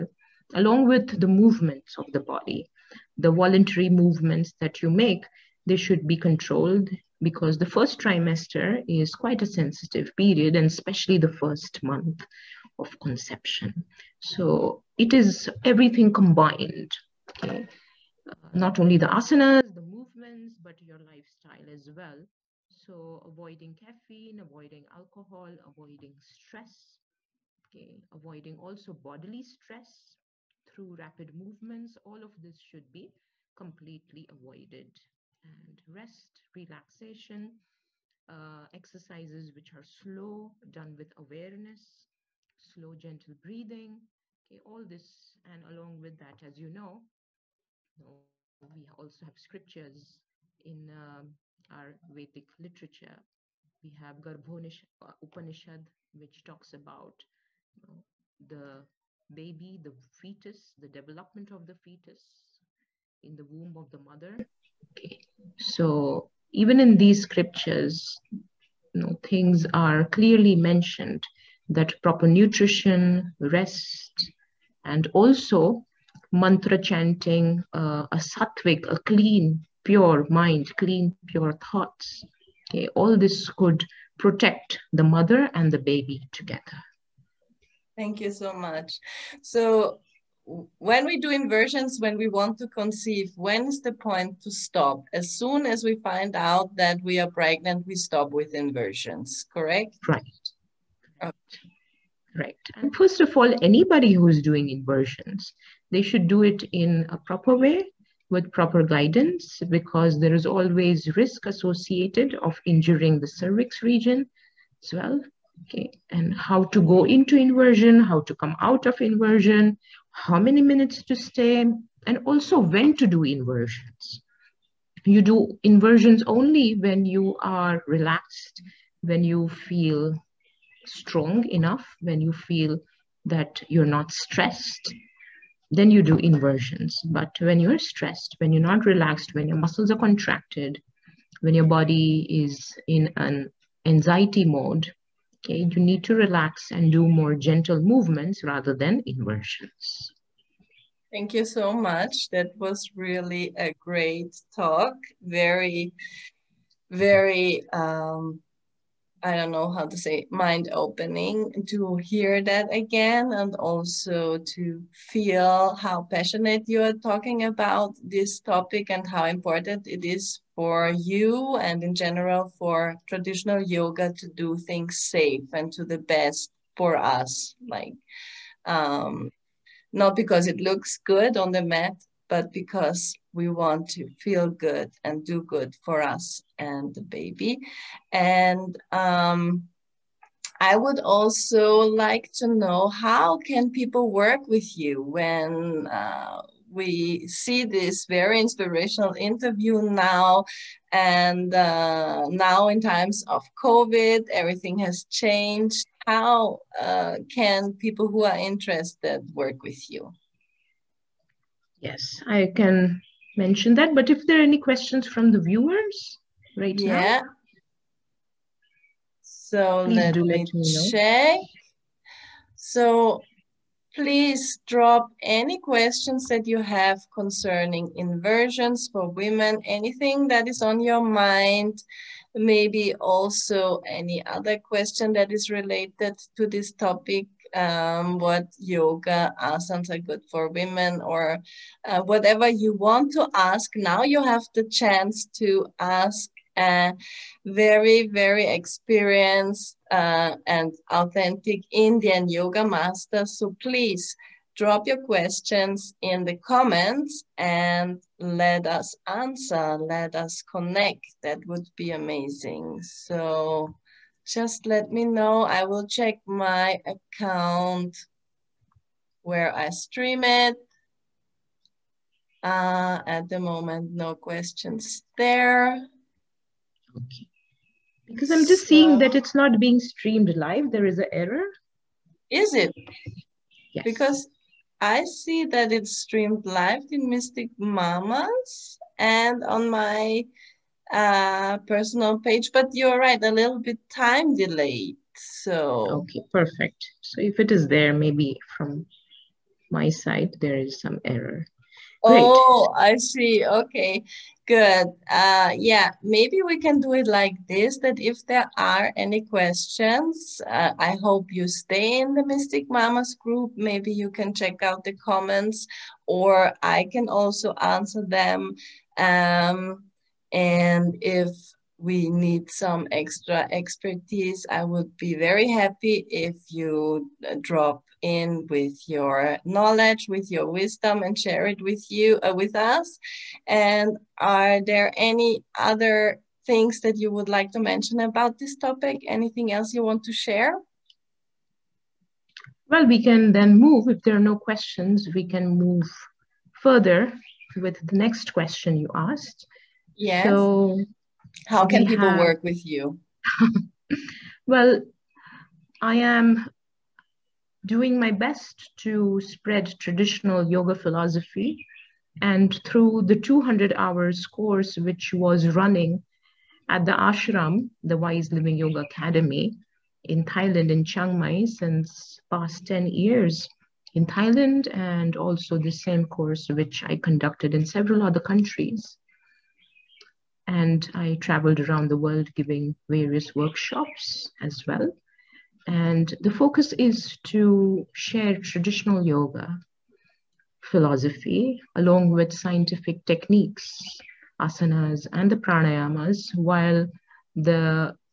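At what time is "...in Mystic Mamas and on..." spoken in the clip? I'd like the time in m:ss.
4:46.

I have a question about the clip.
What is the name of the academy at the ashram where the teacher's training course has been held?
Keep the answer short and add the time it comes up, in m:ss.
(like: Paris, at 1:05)
Wise Living Yoga Academy, at 6:07.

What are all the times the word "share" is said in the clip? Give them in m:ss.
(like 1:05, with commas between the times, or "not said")
5:31, 5:40, 6:27.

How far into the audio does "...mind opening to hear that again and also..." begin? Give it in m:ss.
2:40.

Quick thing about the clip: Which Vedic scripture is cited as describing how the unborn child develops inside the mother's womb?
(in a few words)
Garbhonish Upanishad.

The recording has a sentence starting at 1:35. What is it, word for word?
As soon as we find out that we are pregnant, we stop with inversions, correct?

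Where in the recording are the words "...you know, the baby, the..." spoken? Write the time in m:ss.
0:57.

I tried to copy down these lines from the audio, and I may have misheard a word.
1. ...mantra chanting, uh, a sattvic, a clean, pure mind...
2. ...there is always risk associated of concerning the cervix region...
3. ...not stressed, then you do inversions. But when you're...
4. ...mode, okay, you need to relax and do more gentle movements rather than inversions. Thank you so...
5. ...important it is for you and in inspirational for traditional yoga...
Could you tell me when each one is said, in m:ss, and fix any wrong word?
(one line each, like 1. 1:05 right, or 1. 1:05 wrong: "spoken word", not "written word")
1. 1:16 right
2. 1:50 wrong: "injuring", not "concerning"
3. 2:13 right
4. 2:24 right
5. 2:49 wrong: "general", not "inspirational".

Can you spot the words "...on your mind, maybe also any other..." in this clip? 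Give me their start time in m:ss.
3:50.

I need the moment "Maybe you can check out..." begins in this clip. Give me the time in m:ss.
5:13.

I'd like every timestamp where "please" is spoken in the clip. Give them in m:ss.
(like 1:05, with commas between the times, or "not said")
3:43, 4:13.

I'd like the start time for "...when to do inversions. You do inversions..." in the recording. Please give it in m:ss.
2:02.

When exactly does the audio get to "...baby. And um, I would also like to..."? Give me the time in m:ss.
3:07.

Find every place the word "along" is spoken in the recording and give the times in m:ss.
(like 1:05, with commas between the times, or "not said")
0:00, 0:45, 6:31.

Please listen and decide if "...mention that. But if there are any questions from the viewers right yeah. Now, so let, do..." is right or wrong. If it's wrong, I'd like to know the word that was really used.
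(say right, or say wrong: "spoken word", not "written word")
right.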